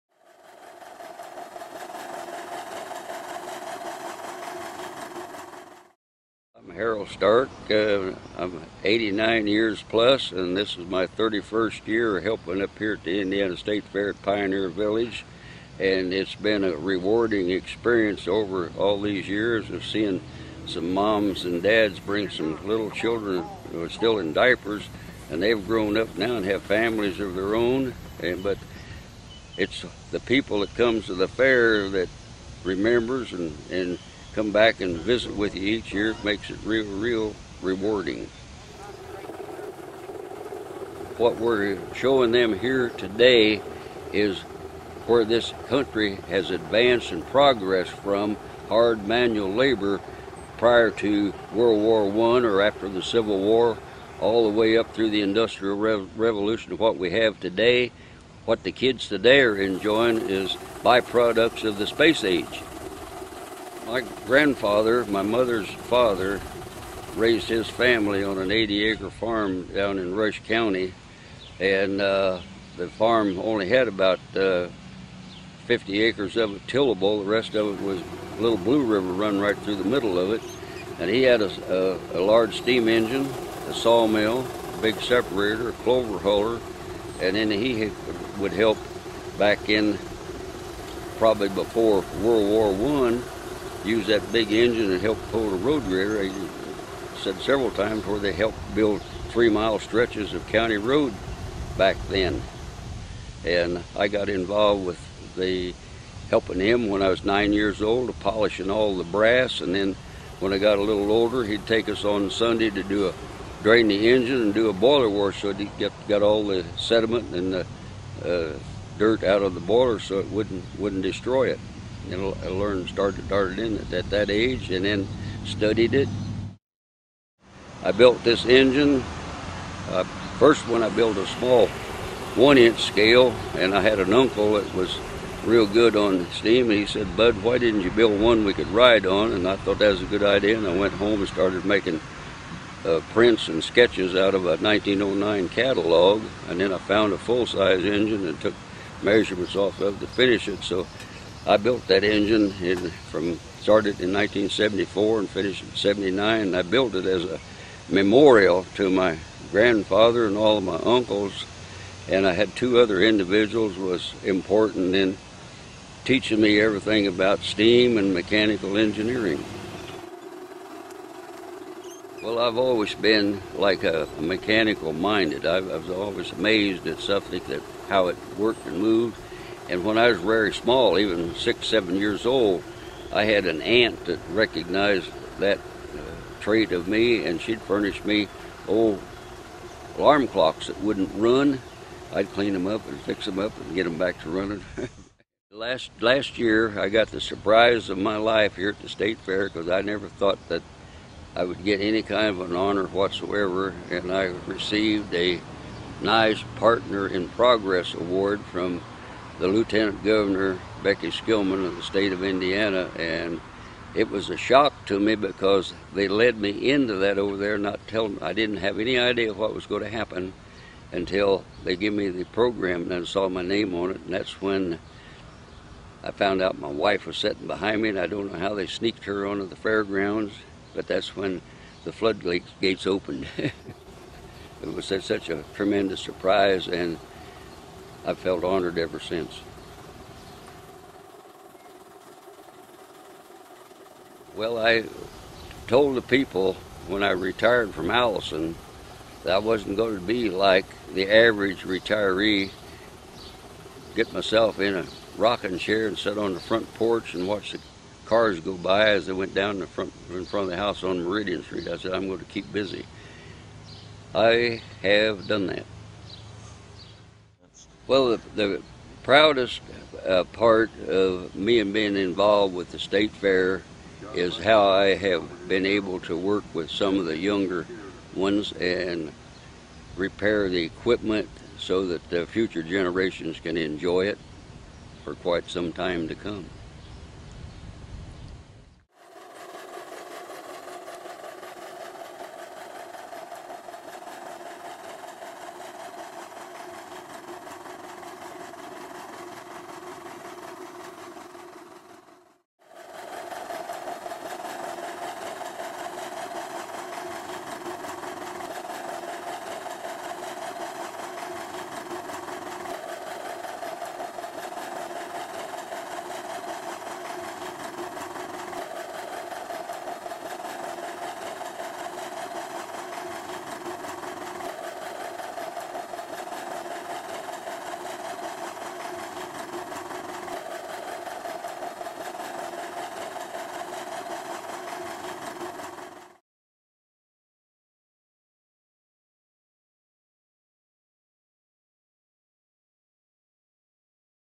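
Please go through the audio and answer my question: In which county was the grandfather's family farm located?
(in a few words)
Rush County.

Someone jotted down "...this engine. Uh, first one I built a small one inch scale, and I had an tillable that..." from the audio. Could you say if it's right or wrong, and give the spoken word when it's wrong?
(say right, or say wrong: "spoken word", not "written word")
wrong: "uncle", not "tillable".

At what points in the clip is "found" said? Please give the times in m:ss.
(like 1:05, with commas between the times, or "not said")
2:26, 3:46.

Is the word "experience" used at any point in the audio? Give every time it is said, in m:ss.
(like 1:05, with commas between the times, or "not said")
0:17.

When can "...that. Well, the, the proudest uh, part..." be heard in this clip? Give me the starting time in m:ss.
4:25.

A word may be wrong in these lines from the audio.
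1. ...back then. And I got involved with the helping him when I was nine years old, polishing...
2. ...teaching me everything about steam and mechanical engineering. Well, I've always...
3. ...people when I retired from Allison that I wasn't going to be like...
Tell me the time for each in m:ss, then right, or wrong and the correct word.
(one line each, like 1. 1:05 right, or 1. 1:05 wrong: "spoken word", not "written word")
1. 1:41 right
2. 2:46 right
3. 4:06 right.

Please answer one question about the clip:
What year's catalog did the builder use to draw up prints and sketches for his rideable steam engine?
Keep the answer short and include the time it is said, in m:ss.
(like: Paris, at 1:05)
1909, at 2:24.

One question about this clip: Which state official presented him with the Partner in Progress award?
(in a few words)
Becky Skillman.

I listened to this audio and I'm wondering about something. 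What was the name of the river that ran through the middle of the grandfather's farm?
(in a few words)
Little Blue River.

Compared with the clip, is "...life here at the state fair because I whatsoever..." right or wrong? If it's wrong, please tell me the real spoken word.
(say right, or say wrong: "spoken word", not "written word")
wrong: "never", not "whatsoever".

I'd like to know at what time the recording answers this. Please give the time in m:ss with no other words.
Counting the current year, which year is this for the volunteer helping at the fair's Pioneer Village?
0:11.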